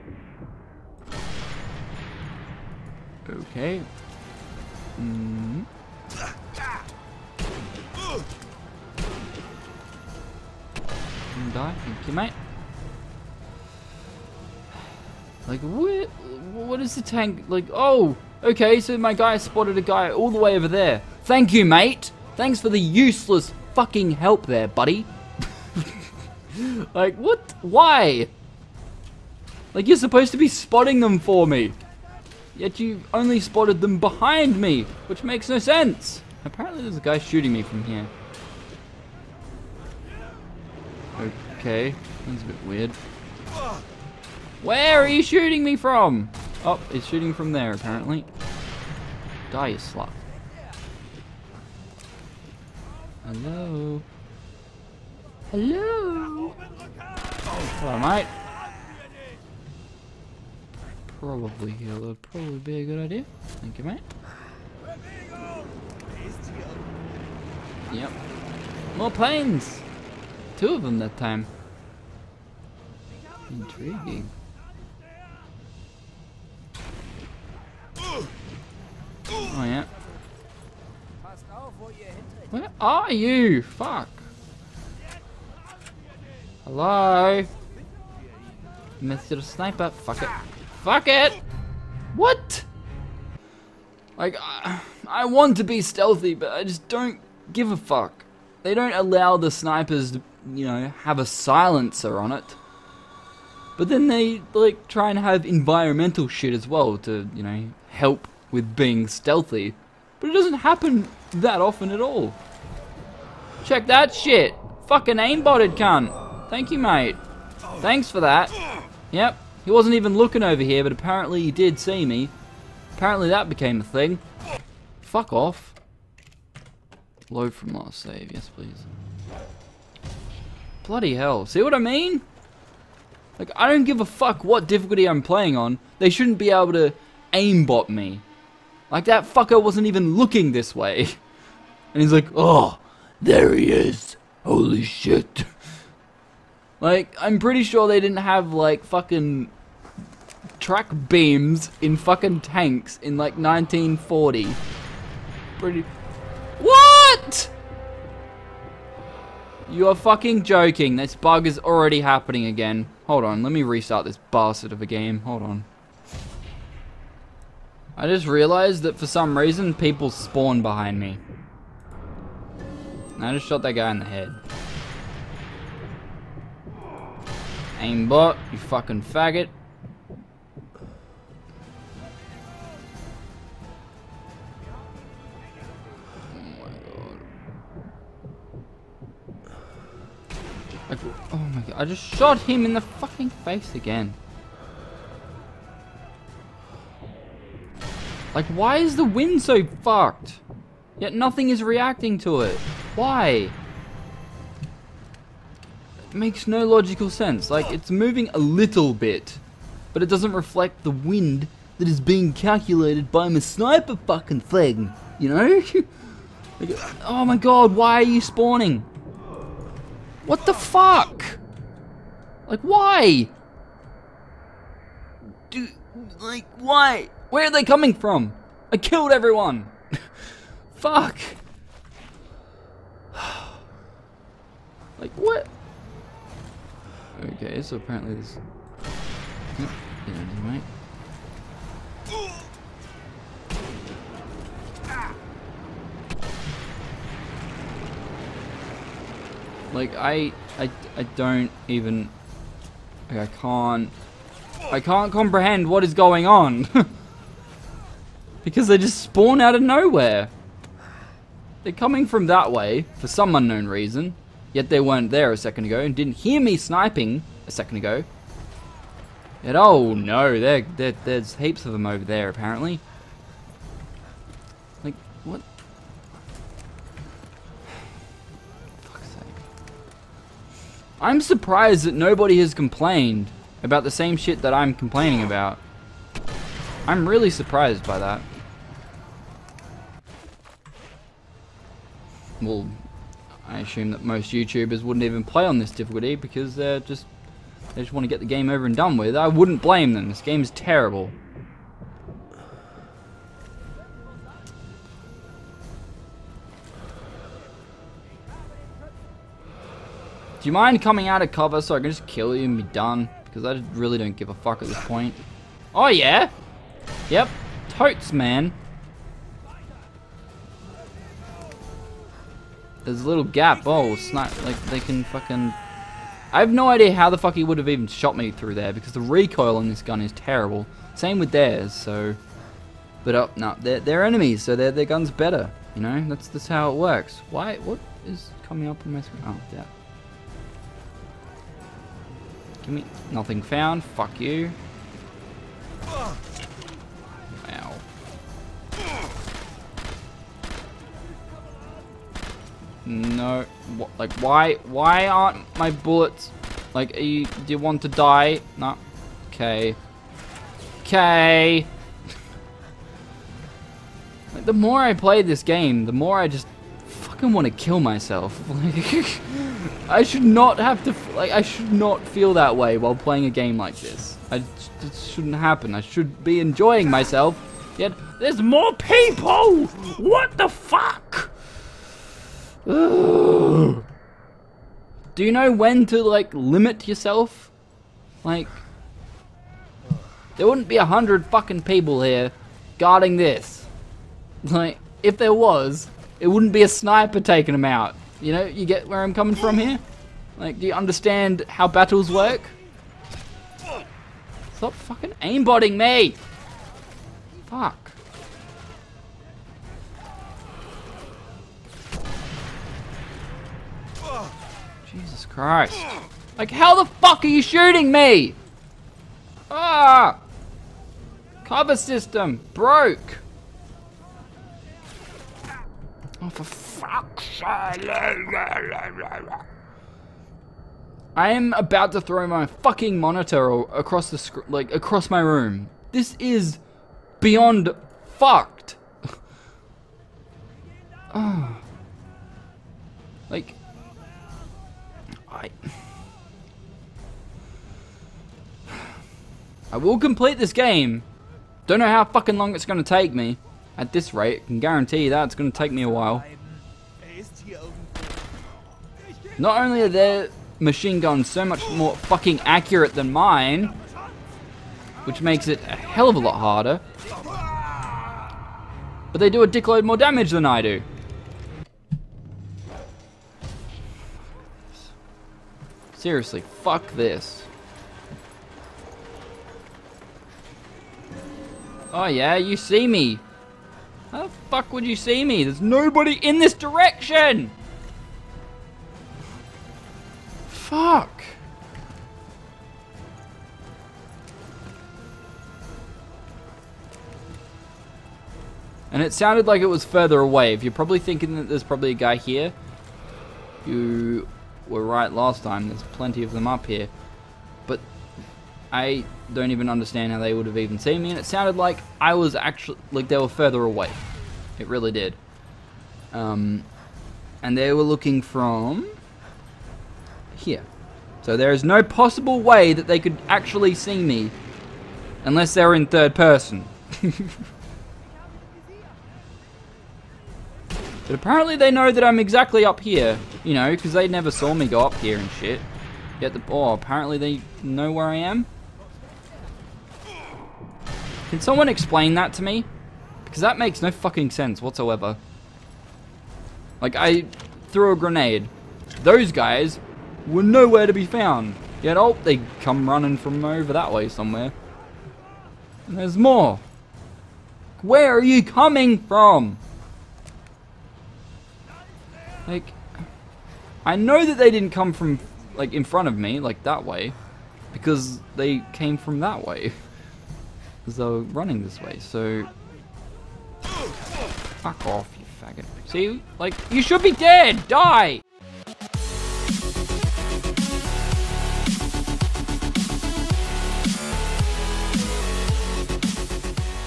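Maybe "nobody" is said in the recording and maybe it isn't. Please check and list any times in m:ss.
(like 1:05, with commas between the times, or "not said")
4:41, 8:05.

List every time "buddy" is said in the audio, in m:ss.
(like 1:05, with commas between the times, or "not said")
0:24.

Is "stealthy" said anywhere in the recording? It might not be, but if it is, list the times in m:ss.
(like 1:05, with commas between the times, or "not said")
1:35, 1:49.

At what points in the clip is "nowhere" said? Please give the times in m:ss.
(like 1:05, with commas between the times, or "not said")
4:19, 9:10.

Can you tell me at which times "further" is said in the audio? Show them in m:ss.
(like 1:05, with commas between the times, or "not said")
8:19, 8:33.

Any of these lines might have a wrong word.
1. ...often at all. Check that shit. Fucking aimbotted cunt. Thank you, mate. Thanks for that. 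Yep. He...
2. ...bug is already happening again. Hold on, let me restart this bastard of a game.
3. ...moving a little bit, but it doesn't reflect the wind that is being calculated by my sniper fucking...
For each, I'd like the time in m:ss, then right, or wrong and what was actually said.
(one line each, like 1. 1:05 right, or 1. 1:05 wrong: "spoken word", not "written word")
1. 1:51 right
2. 2:41 right
3. 3:27 right.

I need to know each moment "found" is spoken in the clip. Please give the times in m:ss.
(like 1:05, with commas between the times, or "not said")
5:43, 9:11.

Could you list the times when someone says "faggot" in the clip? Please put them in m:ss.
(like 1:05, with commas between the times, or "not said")
2:59, 9:35.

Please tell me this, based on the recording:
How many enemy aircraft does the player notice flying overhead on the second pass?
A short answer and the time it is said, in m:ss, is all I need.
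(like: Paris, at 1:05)
2, at 1:10.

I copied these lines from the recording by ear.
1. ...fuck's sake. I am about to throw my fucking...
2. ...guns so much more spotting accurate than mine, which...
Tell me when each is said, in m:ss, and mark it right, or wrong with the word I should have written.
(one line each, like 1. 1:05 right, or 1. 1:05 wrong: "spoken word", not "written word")
1. 7:06 right
2. 7:41 wrong: "fucking", not "spotting".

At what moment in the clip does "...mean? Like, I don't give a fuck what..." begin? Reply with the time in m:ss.
2:11.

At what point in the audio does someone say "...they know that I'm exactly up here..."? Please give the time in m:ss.
8:51.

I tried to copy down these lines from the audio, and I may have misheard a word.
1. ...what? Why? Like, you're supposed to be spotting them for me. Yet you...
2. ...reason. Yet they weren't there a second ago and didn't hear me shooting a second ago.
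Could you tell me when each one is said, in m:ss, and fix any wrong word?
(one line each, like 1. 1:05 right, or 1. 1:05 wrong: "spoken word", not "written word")
1. 0:27 right
2. 4:23 wrong: "sniping", not "shooting".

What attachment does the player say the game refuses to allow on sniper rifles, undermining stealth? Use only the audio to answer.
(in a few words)
A silencer.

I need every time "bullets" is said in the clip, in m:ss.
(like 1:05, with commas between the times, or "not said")
5:55.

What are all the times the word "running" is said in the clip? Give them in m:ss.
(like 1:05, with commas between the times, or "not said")
9:12, 9:31.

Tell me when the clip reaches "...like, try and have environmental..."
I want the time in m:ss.
1:44.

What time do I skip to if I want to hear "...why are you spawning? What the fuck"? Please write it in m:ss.
3:37.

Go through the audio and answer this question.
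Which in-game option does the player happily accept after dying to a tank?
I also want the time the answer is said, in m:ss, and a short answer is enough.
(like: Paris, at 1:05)
Load from last save, at 2:07.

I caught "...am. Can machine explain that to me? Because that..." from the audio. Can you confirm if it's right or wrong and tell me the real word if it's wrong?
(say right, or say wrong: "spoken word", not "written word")
wrong: "someone", not "machine".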